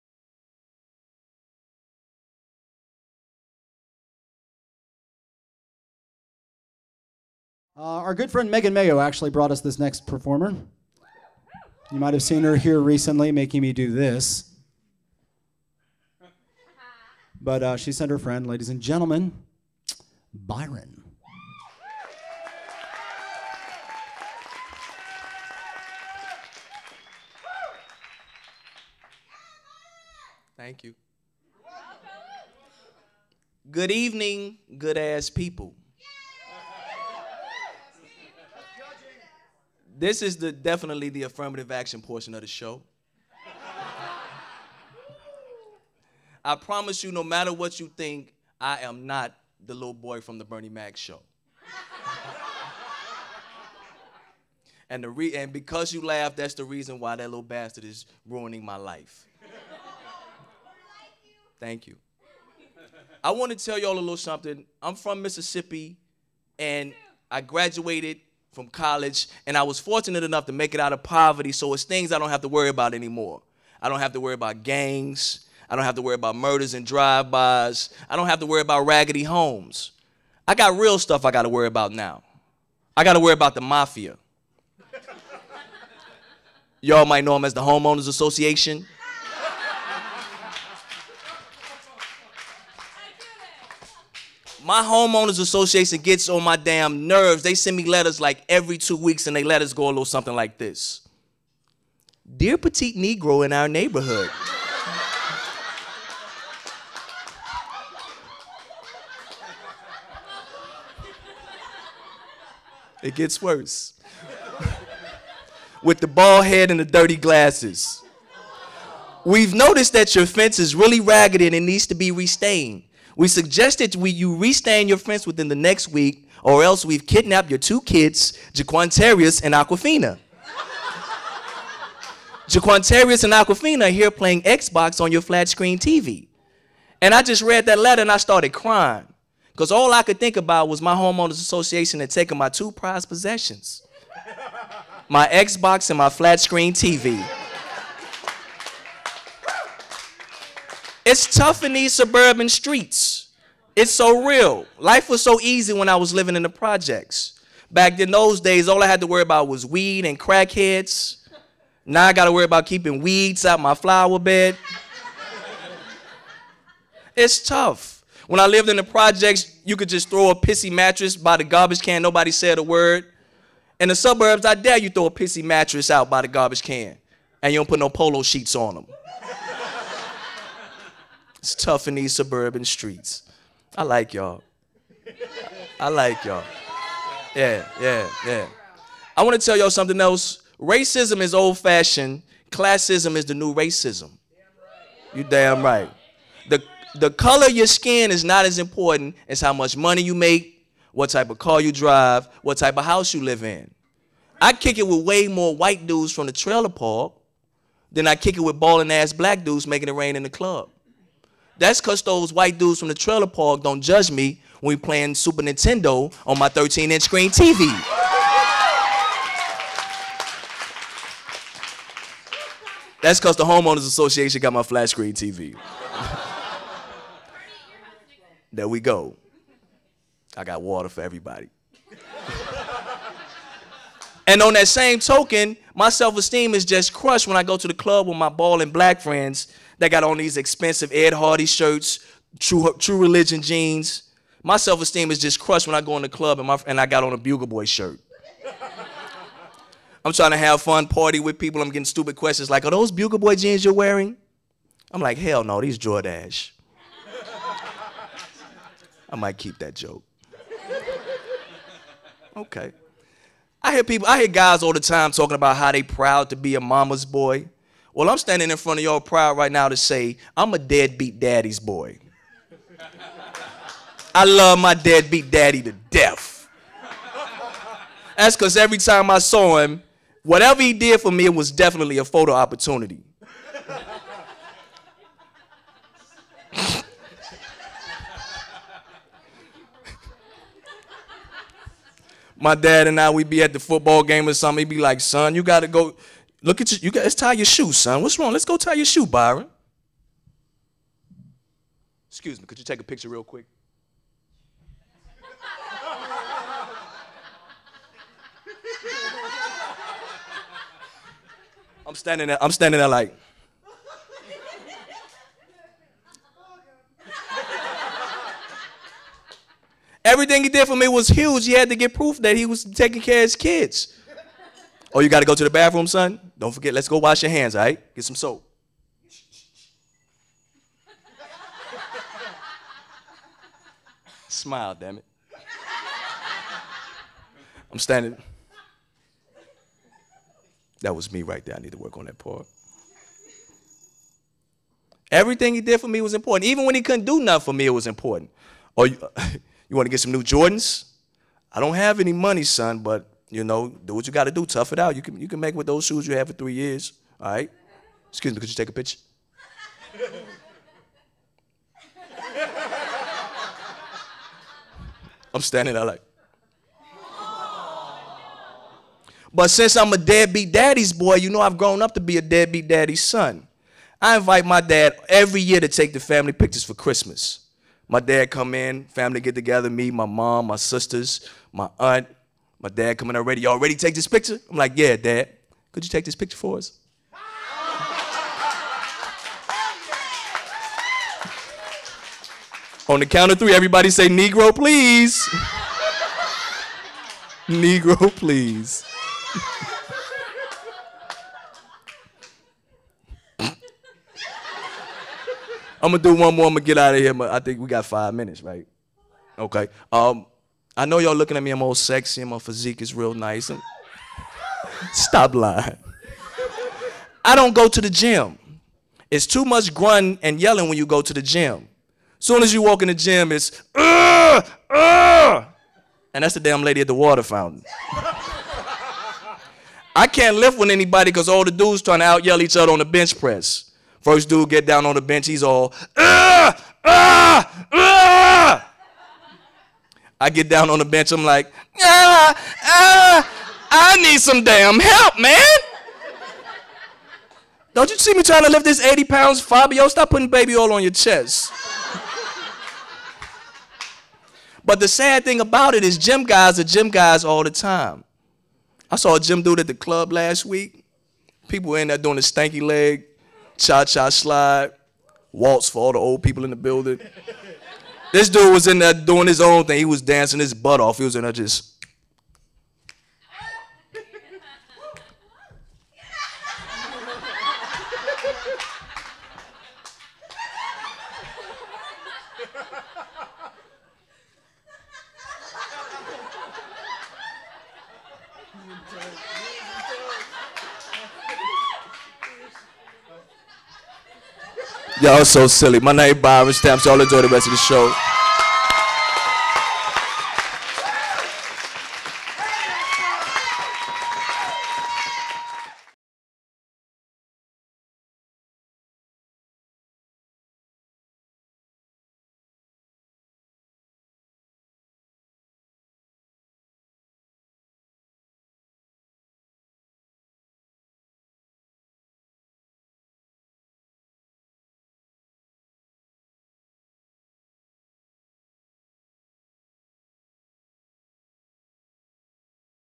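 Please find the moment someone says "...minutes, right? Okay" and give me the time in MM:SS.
06:48.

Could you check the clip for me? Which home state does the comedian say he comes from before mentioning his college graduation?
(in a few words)
Mississippi.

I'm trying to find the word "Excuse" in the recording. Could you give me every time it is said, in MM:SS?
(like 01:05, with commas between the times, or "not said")
05:02, 05:58.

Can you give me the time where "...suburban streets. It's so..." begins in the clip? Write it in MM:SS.
02:31.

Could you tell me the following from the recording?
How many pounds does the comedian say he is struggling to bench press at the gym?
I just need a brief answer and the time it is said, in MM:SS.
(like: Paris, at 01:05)
80, at 07:28.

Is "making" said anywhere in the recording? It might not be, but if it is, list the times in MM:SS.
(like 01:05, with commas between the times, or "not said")
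00:13, 03:29.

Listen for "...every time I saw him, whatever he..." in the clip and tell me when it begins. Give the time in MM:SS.
04:38.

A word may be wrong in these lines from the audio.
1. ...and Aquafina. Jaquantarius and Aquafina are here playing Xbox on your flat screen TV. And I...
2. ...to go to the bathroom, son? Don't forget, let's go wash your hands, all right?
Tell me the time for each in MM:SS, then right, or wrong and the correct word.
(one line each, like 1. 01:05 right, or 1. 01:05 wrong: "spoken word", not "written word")
1. 02:09 right
2. 05:25 right.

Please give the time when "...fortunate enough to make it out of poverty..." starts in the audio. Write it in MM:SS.
01:09.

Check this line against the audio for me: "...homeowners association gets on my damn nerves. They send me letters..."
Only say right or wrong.
right.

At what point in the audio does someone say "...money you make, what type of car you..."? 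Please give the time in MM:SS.
03:19.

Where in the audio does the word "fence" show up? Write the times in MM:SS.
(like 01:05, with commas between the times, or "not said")
02:00, 02:04.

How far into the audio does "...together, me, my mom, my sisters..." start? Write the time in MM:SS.
06:19.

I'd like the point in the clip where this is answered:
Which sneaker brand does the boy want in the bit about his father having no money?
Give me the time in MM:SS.
05:50.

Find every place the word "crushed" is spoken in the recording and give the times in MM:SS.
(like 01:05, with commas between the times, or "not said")
03:56, 04:05.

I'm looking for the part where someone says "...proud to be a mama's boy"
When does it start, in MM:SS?
04:25.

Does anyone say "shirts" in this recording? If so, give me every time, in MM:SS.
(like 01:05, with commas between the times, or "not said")
04:01, 04:07.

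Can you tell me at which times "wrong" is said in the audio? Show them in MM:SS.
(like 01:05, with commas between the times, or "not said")
04:58.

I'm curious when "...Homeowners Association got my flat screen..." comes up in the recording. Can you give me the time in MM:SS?
03:43.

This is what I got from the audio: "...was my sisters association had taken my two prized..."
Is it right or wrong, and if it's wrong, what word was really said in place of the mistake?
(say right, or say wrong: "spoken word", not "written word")
wrong: "homeowners", not "sisters".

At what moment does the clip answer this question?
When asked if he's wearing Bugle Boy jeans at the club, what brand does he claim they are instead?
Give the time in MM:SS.
04:15.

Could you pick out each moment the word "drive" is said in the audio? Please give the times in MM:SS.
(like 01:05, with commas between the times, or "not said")
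01:16, 03:21.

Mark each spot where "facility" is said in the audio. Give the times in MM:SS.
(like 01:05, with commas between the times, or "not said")
not said.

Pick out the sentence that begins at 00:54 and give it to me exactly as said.
and the re- and because you laughed, that's the reason why that little bastard is ruining my life.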